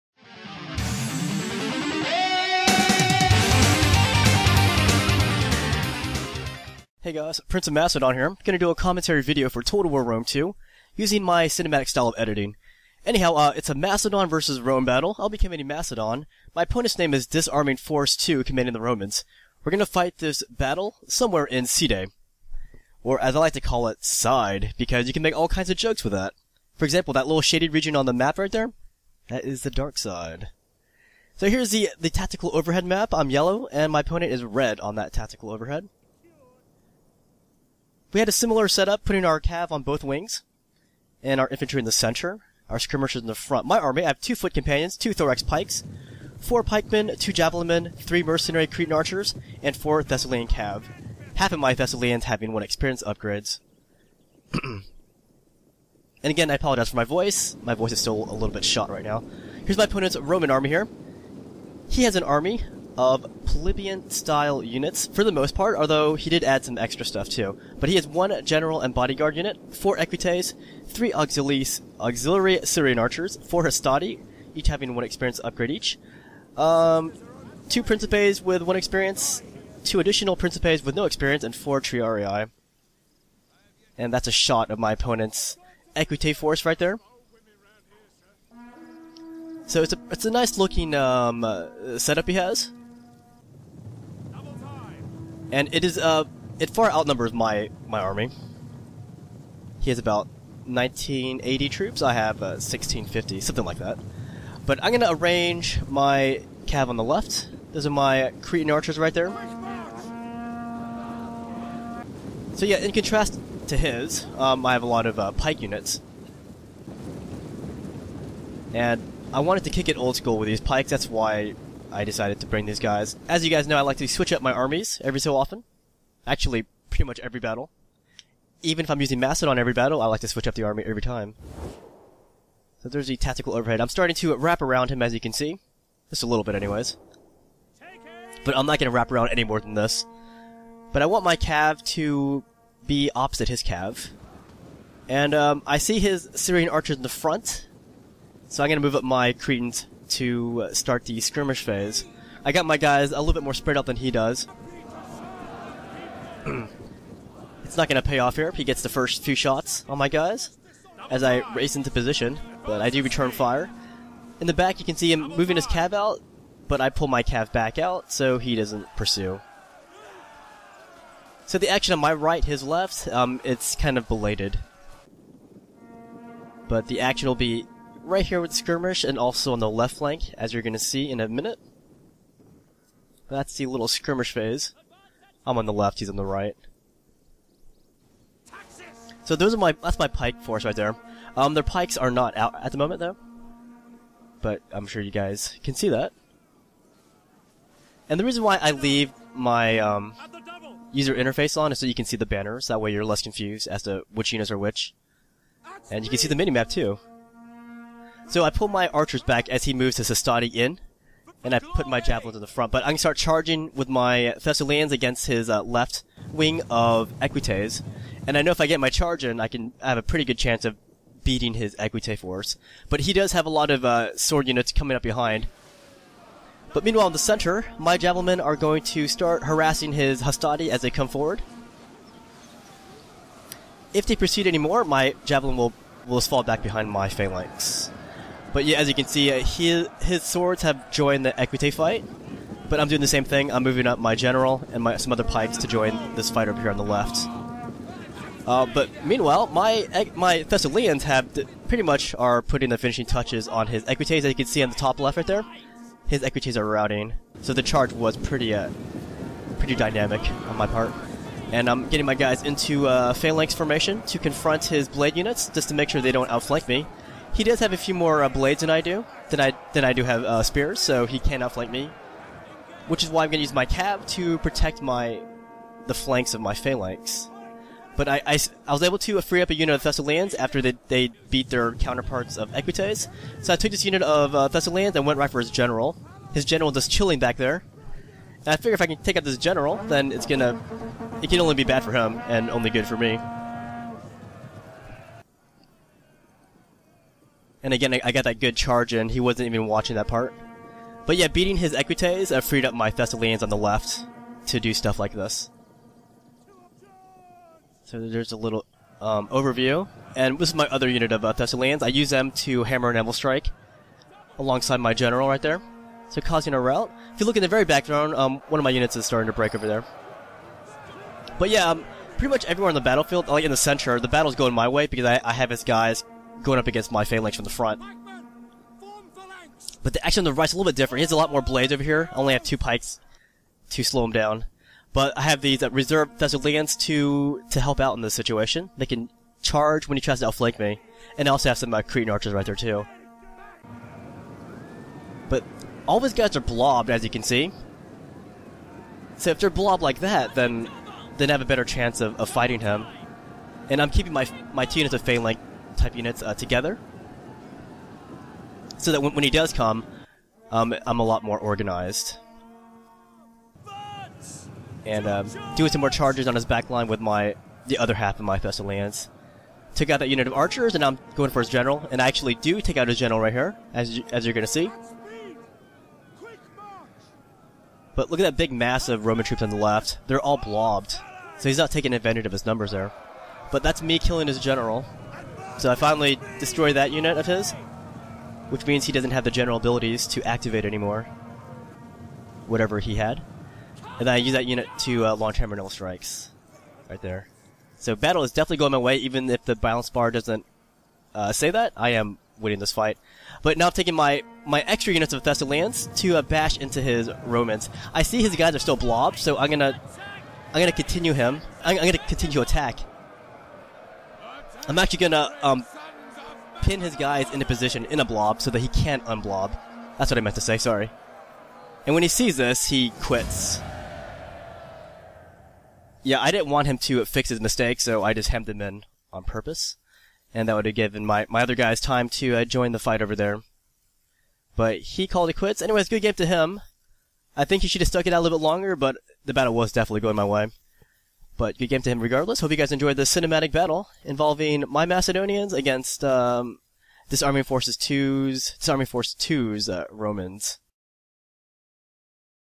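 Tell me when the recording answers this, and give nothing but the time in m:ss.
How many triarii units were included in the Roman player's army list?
1:21.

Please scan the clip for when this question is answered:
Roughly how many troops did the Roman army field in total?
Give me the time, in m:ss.
1:40.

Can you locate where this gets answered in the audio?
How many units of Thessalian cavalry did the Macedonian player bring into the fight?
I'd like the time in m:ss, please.
0:49.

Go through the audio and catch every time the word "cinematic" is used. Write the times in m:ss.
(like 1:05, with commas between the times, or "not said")
0:11, 7:23.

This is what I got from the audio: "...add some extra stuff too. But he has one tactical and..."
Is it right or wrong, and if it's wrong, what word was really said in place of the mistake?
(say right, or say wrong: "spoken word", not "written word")
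wrong: "general", not "tactical".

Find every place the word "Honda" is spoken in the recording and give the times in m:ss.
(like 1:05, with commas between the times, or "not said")
not said.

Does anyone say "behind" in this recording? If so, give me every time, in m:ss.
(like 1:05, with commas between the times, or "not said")
3:45, 3:56.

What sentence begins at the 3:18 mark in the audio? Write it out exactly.
And the reason why I leave my um, user interface on is so you can see the banners.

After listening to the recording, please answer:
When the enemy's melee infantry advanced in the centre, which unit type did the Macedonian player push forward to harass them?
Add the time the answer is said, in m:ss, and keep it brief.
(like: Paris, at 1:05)
javelins, at 3:31.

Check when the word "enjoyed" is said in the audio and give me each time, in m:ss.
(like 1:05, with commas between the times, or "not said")
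7:22.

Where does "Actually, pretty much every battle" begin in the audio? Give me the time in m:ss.
2:06.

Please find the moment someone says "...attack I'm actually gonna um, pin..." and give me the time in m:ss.
6:52.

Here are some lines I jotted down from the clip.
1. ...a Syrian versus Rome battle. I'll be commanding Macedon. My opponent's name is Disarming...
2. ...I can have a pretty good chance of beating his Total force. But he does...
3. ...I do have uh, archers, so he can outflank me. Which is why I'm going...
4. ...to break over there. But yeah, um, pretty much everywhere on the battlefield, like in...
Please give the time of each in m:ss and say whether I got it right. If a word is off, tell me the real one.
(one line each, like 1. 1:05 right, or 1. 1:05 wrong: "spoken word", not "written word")
1. 0:13 wrong: "Macedon", not "Syrian"
2. 3:39 wrong: "Equite", not "Total"
3. 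4:29 wrong: "spears", not "archers"
4. 5:19 right.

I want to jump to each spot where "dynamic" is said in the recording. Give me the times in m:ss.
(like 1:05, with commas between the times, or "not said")
4:19.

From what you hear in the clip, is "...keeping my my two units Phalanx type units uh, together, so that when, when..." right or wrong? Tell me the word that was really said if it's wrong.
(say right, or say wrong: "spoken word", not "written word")
right.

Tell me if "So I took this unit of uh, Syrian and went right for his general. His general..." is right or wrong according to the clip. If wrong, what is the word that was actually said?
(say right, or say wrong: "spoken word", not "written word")
wrong: "Thessalians", not "Syrian".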